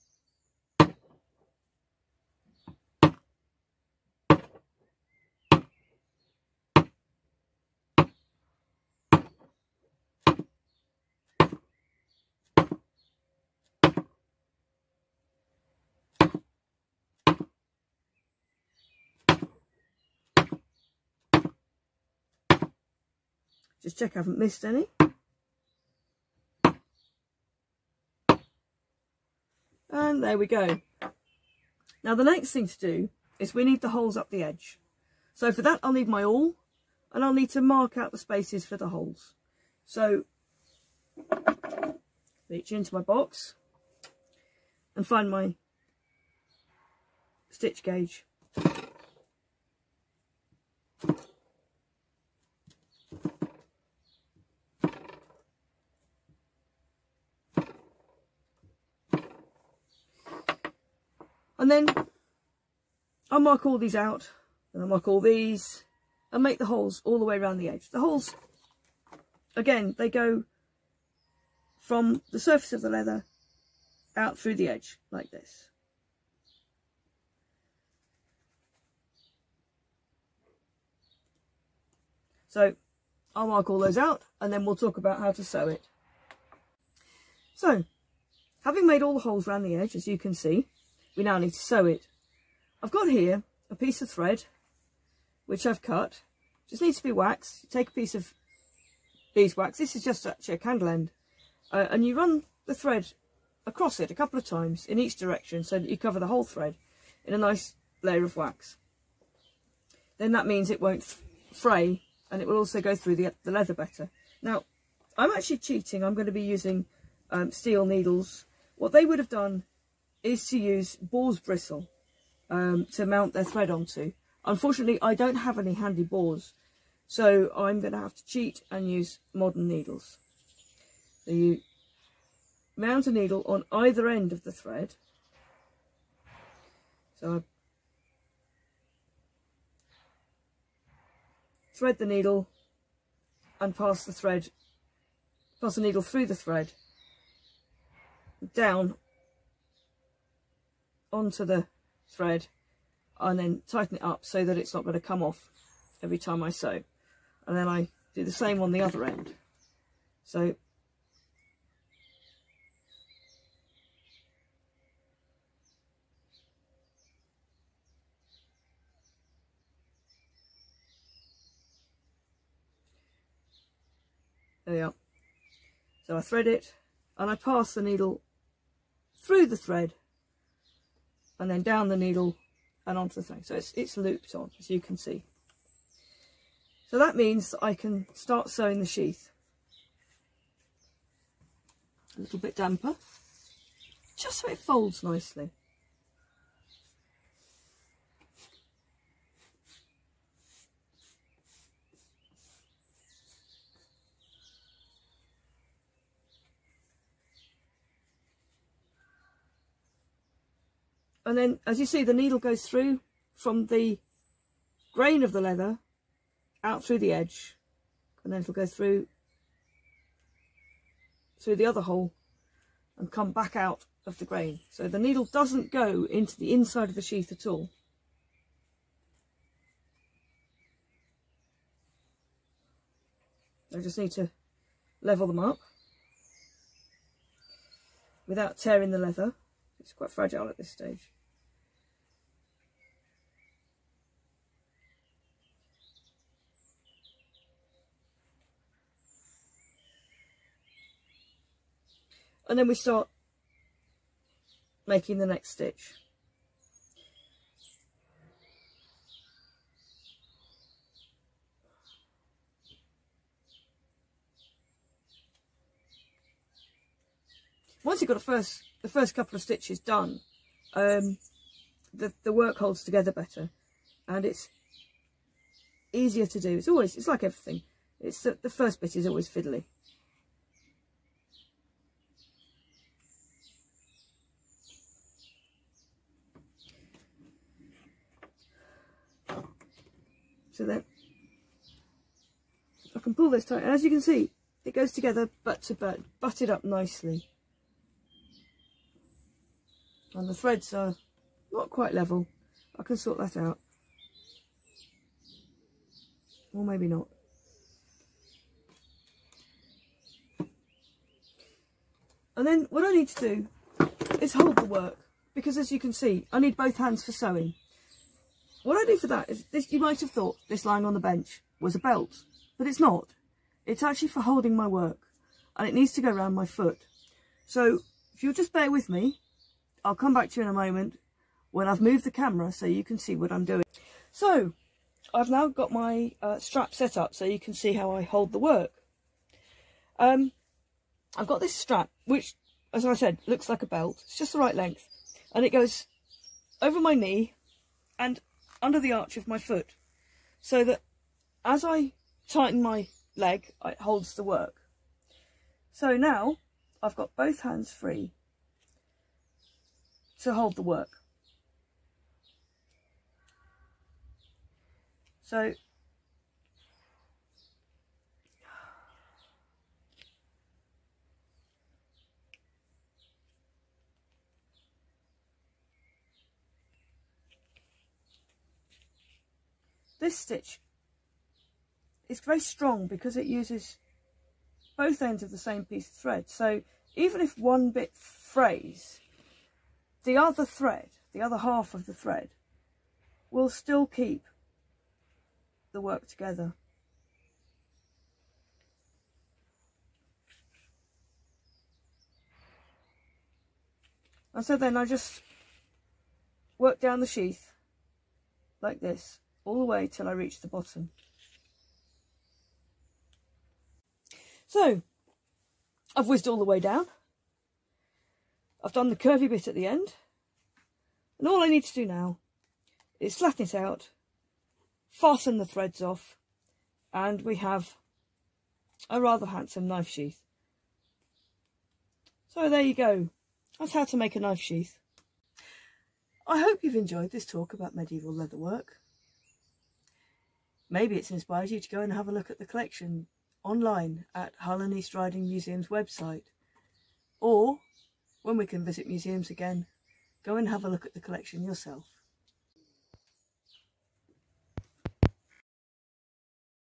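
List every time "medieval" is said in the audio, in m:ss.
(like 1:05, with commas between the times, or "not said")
7:17.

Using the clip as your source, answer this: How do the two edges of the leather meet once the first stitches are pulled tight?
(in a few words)
Butt to butt.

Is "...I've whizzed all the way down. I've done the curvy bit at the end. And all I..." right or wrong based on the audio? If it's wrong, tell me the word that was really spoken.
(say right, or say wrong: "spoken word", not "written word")
right.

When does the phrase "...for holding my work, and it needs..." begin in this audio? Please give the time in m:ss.
5:24.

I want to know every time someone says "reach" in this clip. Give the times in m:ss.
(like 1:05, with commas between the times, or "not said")
0:42, 6:50.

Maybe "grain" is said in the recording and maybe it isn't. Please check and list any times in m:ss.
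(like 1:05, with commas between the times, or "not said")
3:34, 3:44.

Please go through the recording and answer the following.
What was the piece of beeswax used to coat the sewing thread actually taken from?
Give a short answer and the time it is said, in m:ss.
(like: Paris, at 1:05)
A candle end, at 1:40.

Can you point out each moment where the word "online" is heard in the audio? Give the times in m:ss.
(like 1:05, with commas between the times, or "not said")
7:23.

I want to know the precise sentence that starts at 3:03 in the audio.
So it's, it's looped on, as you can see.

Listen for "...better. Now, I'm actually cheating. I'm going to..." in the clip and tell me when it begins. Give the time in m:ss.
1:53.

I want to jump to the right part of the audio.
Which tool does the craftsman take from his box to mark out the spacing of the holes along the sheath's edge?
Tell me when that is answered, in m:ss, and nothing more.
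0:47.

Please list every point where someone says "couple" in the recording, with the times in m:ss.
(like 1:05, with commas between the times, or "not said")
1:44, 4:29.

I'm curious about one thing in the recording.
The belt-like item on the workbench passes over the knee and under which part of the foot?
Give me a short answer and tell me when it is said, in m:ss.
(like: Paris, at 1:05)
The arch, at 5:48.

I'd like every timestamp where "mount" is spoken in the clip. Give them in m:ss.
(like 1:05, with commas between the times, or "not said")
2:03, 2:12.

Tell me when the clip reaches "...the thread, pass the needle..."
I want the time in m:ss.
2:24.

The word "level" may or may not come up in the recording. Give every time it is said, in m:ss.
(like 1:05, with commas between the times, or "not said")
3:55, 5:01.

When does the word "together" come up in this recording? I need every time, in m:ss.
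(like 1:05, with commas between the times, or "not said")
4:32, 4:54, 6:36.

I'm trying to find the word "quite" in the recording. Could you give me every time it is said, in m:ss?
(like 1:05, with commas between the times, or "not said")
3:59, 5:01.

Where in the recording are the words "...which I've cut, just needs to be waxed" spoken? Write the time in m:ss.
1:35.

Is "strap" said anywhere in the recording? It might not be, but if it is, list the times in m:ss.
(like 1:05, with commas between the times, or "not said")
5:36, 5:41.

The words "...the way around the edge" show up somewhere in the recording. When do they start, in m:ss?
1:07.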